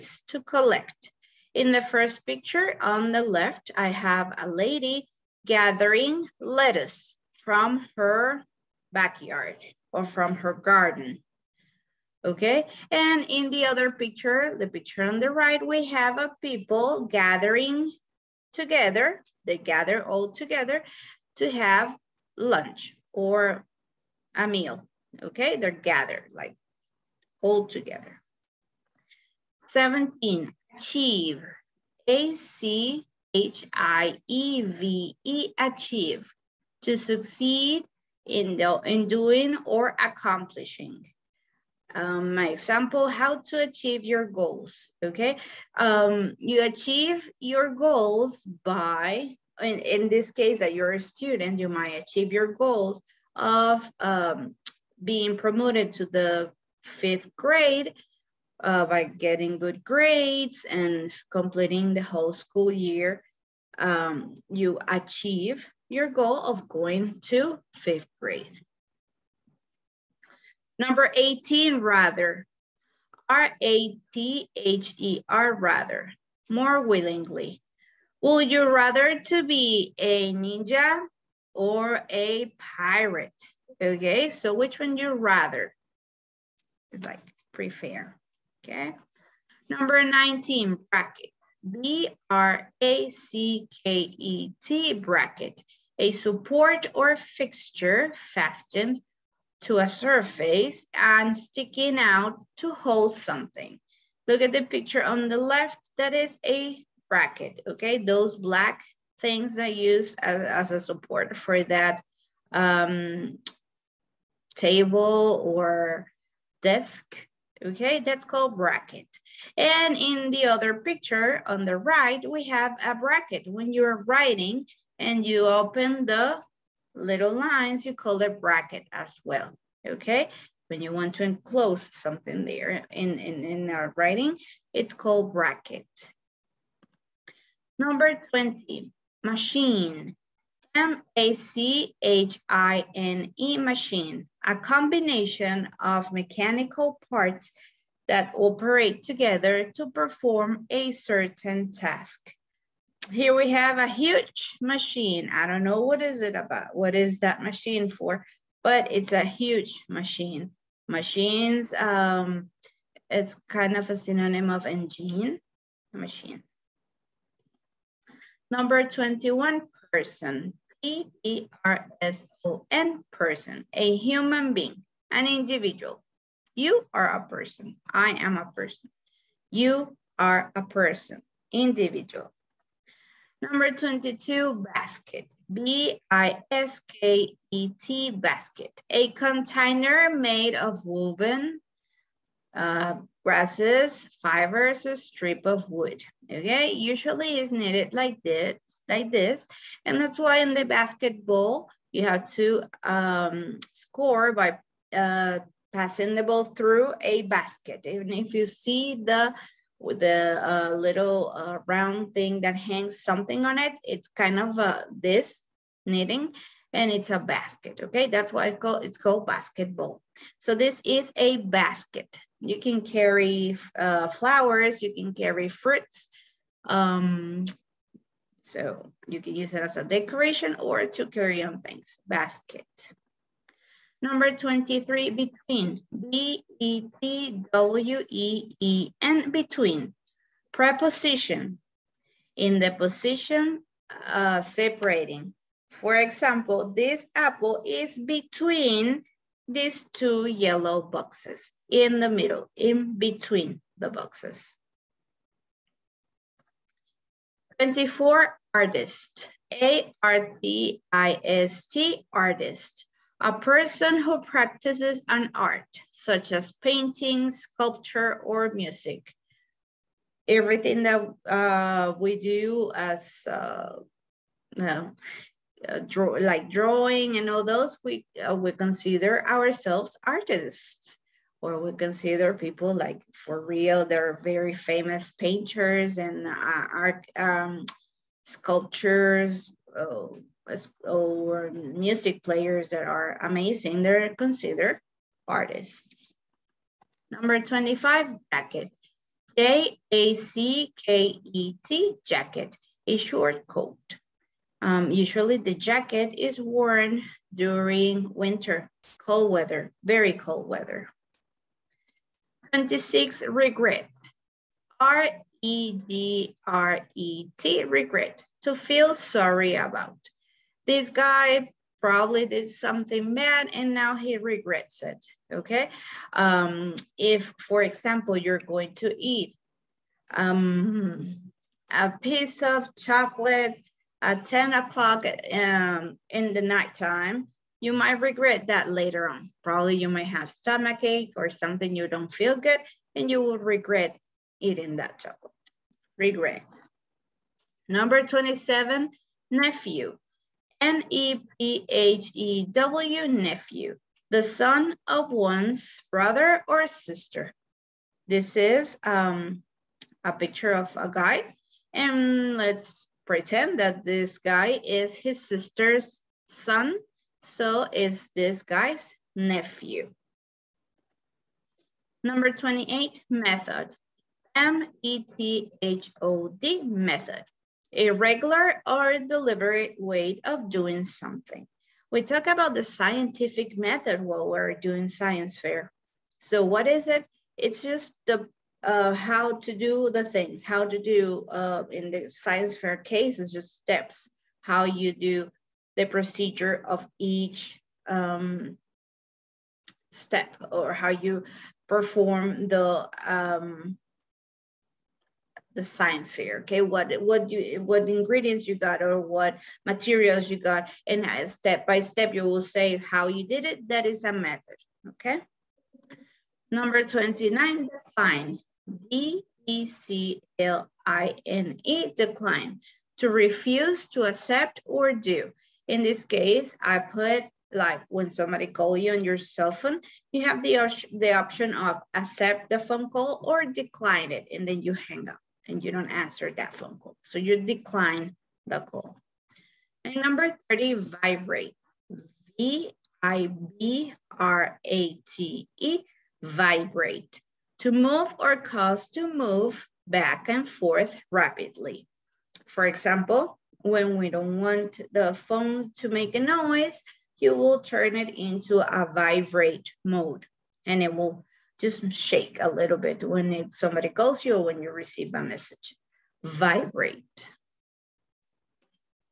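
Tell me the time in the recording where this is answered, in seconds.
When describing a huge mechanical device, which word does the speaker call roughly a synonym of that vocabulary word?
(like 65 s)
164 s.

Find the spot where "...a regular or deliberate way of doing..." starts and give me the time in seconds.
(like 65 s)
377 s.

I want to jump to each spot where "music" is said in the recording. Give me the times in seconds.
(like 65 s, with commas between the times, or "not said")
268 s, 291 s.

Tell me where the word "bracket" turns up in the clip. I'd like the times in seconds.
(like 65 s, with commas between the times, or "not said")
90 s, 94 s, 107 s, 118 s, 122 s, 128 s, 135 s.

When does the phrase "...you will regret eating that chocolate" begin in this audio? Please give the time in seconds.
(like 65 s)
343 s.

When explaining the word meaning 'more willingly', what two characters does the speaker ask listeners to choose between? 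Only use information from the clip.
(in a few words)
a ninja or a pirate.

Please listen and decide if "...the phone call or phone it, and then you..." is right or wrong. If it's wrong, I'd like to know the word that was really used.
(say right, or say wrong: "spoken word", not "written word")
wrong: "decline", not "phone".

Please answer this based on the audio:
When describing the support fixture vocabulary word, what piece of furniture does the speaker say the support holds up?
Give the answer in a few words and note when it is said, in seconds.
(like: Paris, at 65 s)
table or desk, at 114 s.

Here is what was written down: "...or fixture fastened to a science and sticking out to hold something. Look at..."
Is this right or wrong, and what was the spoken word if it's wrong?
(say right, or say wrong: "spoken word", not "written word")
wrong: "surface", not "science".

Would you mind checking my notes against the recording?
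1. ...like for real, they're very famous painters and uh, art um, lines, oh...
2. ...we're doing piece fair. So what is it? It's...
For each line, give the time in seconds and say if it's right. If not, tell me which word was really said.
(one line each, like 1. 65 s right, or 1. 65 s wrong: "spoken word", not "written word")
1. 282 s wrong: "sculptures", not "lines"
2. 384 s wrong: "science", not "piece".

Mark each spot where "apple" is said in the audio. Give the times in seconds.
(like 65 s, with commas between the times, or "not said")
247 s.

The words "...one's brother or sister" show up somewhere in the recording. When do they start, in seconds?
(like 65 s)
355 s.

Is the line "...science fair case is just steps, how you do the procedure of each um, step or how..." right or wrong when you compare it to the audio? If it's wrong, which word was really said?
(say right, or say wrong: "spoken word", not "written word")
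right.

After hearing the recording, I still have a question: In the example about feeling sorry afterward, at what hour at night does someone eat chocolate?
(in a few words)
10 o'clock.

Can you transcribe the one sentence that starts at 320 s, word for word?
This guy probably did something bad and now he regrets it, okay?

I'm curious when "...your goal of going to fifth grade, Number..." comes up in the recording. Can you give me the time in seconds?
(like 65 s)
65 s.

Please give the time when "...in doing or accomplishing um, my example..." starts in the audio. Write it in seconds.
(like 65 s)
38 s.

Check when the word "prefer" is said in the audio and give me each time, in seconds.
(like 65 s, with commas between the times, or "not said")
87 s.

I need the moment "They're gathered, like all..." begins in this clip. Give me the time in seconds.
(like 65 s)
25 s.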